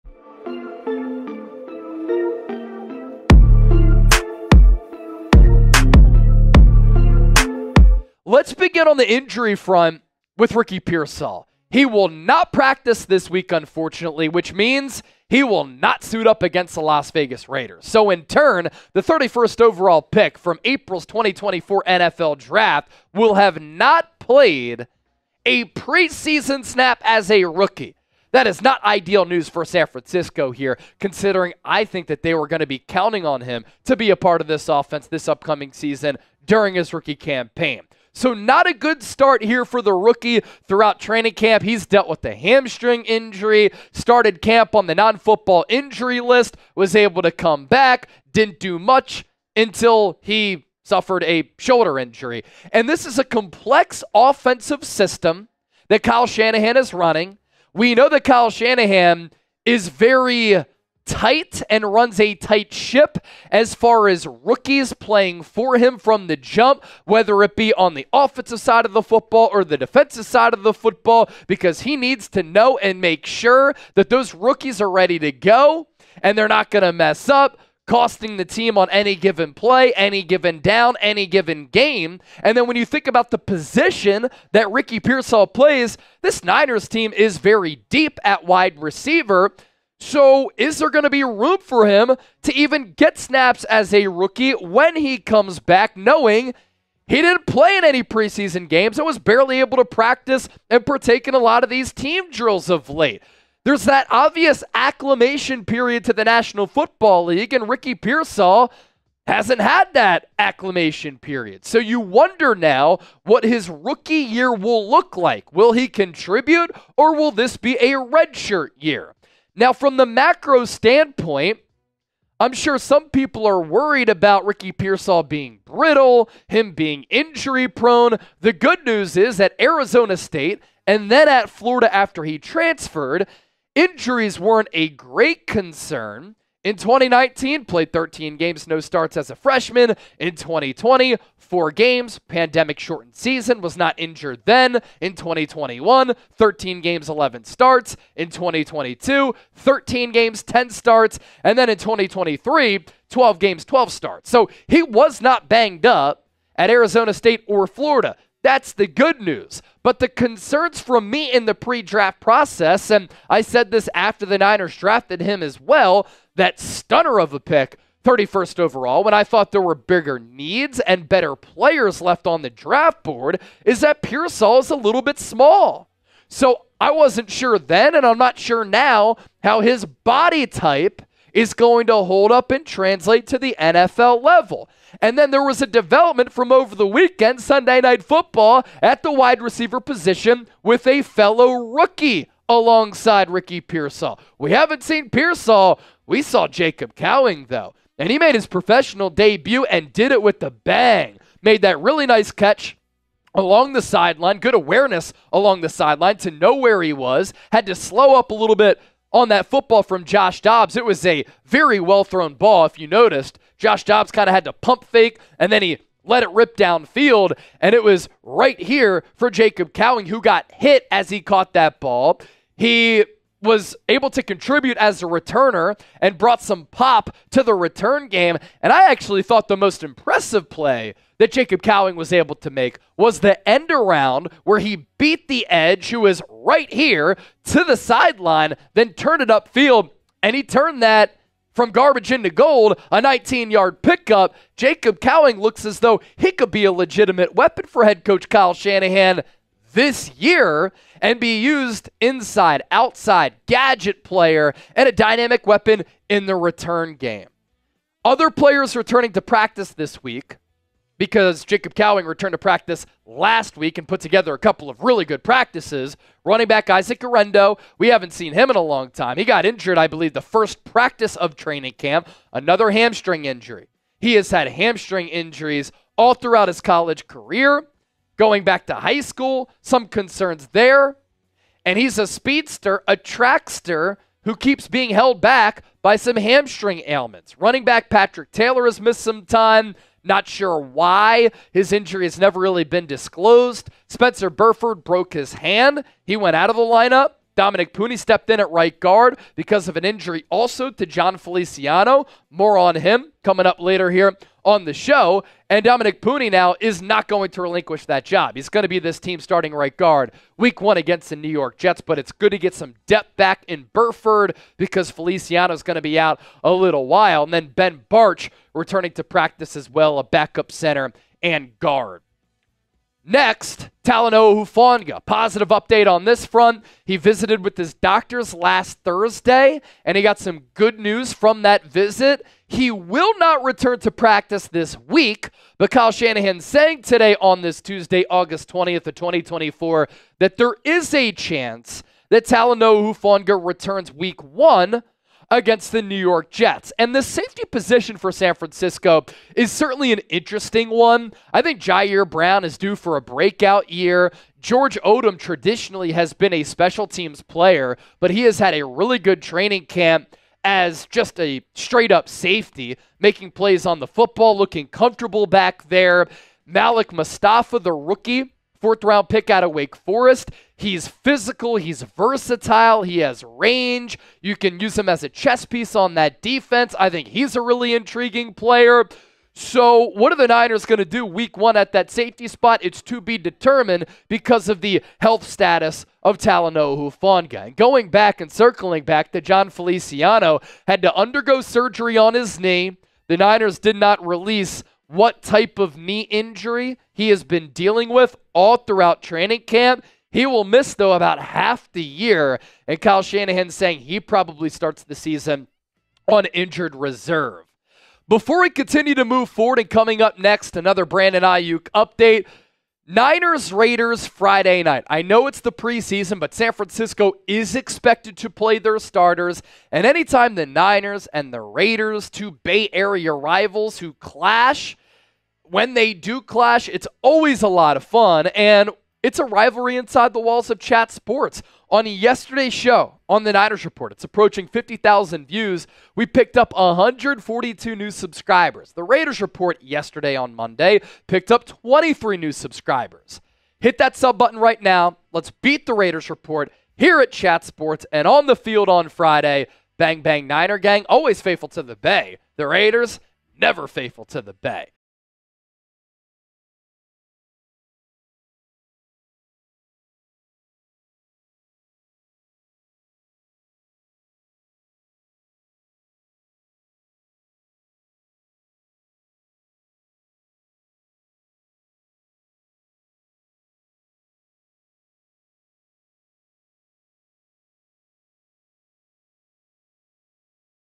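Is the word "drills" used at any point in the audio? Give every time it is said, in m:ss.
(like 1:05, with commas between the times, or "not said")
1:42.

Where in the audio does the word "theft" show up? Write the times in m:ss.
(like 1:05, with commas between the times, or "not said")
not said.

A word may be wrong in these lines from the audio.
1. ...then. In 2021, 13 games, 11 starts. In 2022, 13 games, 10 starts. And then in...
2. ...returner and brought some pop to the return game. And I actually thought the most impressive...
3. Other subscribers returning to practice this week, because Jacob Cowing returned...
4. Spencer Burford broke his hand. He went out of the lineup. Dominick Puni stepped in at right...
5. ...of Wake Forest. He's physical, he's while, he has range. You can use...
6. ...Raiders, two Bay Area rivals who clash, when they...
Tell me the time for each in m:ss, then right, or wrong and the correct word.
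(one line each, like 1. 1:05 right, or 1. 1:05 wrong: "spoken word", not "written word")
1. 2:24 right
2. 3:45 right
3. 4:18 wrong: "players", not "subscribers"
4. 4:53 right
5. 6:09 wrong: "versatile", not "while"
6. 7:01 right.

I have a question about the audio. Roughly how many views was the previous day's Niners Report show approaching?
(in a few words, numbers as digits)
50,000.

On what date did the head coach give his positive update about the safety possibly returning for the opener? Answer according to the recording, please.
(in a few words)
August 20th.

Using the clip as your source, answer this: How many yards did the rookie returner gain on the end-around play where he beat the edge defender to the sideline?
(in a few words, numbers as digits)
19.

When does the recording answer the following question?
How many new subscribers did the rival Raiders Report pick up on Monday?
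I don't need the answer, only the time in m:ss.
7:21.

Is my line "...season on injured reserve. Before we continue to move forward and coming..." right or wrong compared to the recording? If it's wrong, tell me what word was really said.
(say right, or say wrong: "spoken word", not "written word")
right.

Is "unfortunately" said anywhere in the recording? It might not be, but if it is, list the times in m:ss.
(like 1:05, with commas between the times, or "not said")
0:13.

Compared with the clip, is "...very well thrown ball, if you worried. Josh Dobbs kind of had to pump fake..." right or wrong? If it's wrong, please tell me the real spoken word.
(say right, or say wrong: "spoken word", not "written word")
wrong: "noticed", not "worried".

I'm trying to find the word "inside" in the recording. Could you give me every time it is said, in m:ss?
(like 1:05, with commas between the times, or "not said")
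4:11, 7:09.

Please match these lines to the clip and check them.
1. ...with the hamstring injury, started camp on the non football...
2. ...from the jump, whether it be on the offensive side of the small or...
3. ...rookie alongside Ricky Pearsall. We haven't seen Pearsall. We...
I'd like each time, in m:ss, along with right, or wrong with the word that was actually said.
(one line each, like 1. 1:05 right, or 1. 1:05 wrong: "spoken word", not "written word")
1. 0:42 right
2. 1:05 wrong: "football", not "small"
3. 3:11 right.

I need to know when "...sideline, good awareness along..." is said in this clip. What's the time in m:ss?
3:23.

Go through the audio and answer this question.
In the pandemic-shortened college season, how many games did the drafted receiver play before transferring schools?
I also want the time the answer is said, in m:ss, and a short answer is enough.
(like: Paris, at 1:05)
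4, at 2:21.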